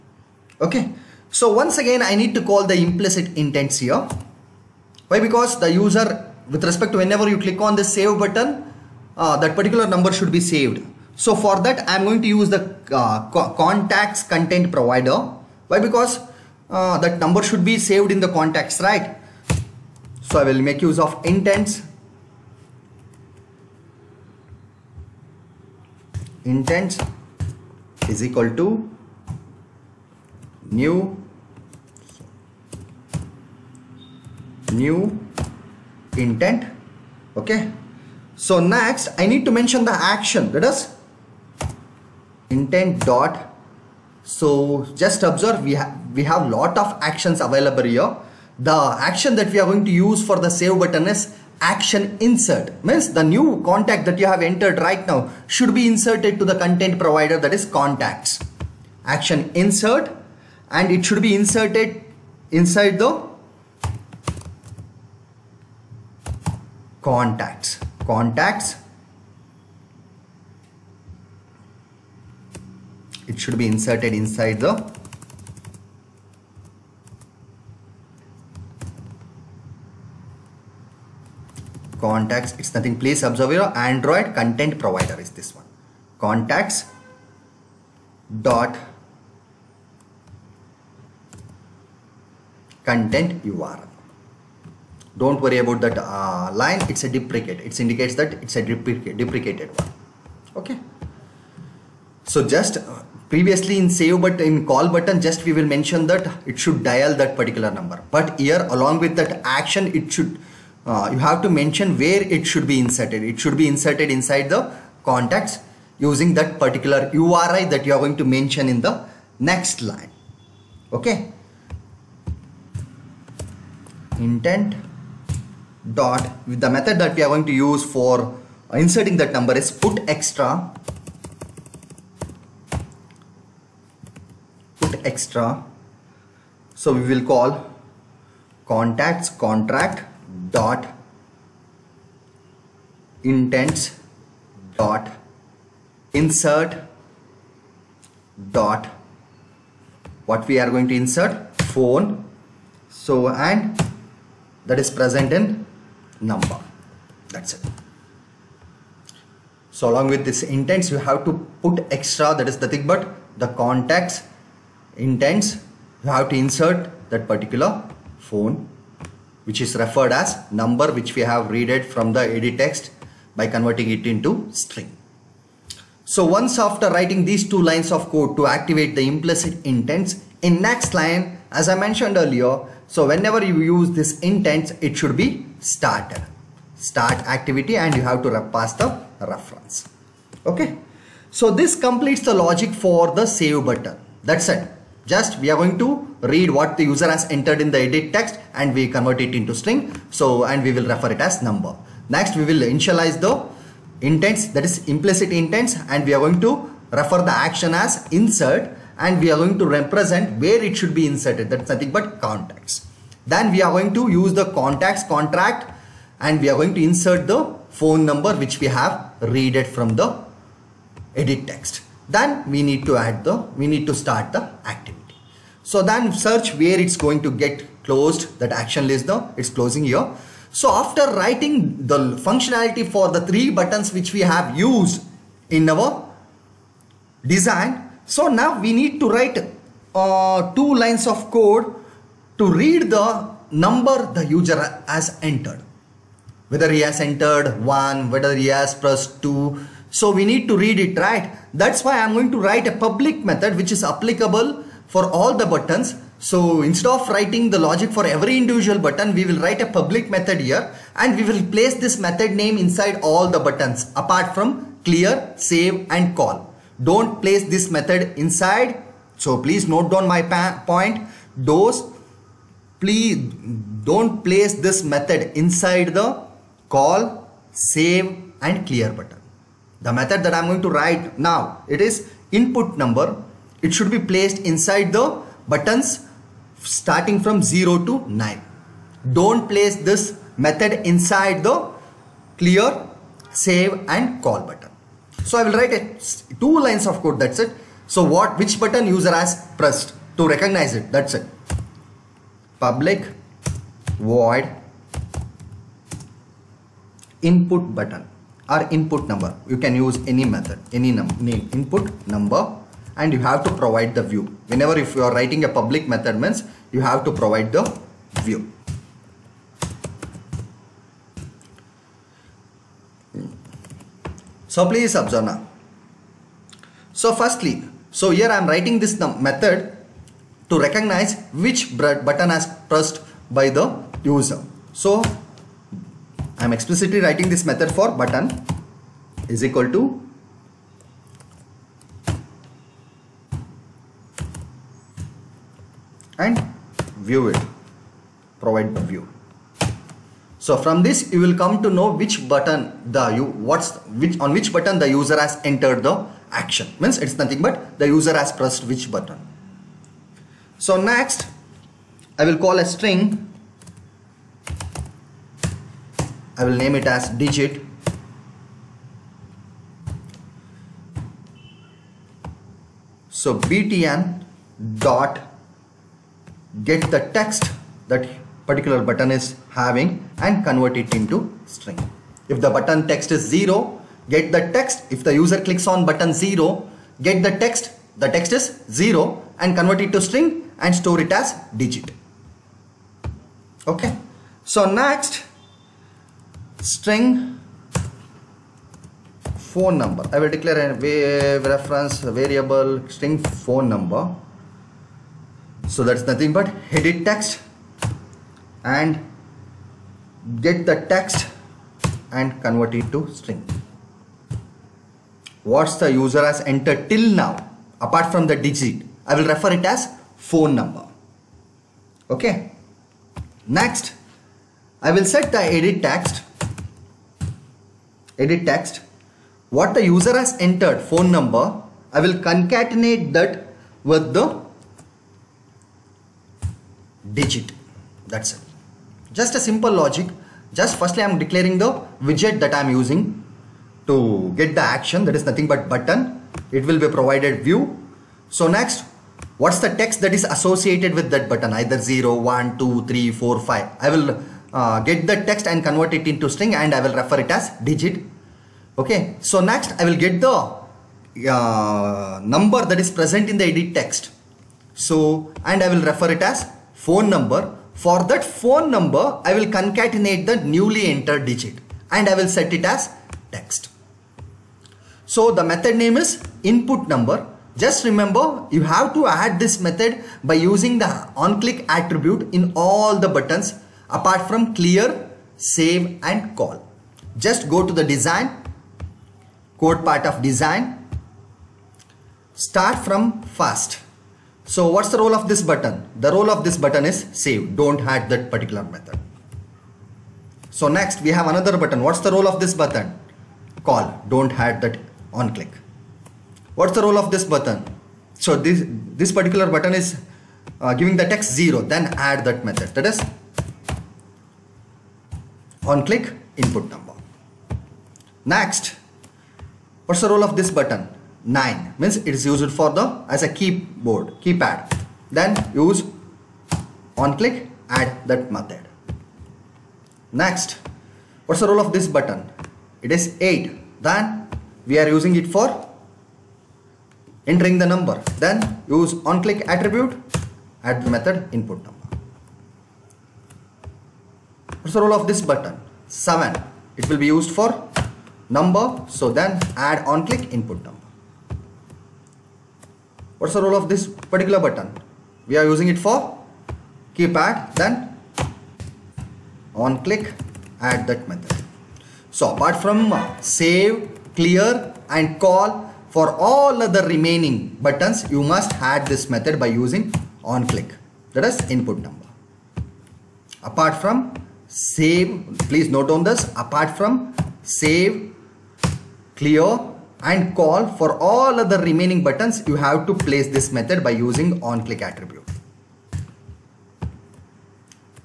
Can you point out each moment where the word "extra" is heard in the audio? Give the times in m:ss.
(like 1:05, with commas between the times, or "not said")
2:10, 2:15, 2:41.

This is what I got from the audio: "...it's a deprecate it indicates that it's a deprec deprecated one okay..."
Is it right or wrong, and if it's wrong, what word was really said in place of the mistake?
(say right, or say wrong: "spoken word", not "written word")
right.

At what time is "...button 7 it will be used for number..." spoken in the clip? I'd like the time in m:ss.
9:05.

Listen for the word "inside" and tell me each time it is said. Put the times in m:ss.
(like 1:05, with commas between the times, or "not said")
1:02, 1:14, 1:54, 4:22, 4:28, 4:35, 4:44, 4:50.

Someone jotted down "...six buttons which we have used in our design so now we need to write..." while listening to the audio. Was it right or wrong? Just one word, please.
wrong.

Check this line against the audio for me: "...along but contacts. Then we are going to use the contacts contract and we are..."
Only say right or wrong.
wrong.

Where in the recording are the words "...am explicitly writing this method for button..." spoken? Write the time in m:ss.
5:36.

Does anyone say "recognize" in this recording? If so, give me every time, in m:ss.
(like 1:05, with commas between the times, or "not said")
5:00, 5:30.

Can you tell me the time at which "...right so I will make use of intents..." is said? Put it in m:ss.
0:18.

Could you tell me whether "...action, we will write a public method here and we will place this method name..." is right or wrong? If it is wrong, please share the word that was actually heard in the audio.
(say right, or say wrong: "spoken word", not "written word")
wrong: "button", not "action".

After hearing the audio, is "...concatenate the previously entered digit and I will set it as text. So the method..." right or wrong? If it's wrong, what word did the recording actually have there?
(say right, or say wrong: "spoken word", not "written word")
wrong: "newly", not "previously".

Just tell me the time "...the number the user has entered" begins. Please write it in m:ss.
4:02.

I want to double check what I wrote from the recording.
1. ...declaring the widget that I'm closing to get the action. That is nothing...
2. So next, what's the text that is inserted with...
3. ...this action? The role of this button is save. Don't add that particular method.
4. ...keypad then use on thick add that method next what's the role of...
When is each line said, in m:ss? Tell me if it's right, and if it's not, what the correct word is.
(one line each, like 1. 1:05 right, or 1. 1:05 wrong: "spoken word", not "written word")
1. 7:21 wrong: "using", not "closing"
2. 7:28 wrong: "associated", not "inserted"
3. 8:15 wrong: "button", not "action"
4. 8:44 wrong: "click", not "thick".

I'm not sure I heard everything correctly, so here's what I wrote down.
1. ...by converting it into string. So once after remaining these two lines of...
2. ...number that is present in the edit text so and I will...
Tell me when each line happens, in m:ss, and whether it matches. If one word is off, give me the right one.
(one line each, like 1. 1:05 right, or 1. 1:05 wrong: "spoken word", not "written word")
1. 2:53 wrong: "writing", not "remaining"
2. 7:42 right.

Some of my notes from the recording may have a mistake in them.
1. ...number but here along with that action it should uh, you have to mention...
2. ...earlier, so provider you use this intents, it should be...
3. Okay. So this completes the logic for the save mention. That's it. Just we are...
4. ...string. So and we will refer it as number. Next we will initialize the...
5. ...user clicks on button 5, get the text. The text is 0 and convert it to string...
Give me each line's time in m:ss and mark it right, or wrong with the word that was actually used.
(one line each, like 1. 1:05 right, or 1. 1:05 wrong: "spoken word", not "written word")
1. 1:47 right
2. 3:02 wrong: "whenever", not "provider"
3. 3:10 wrong: "button", not "mention"
4. 3:19 right
5. 6:25 wrong: "0", not "5".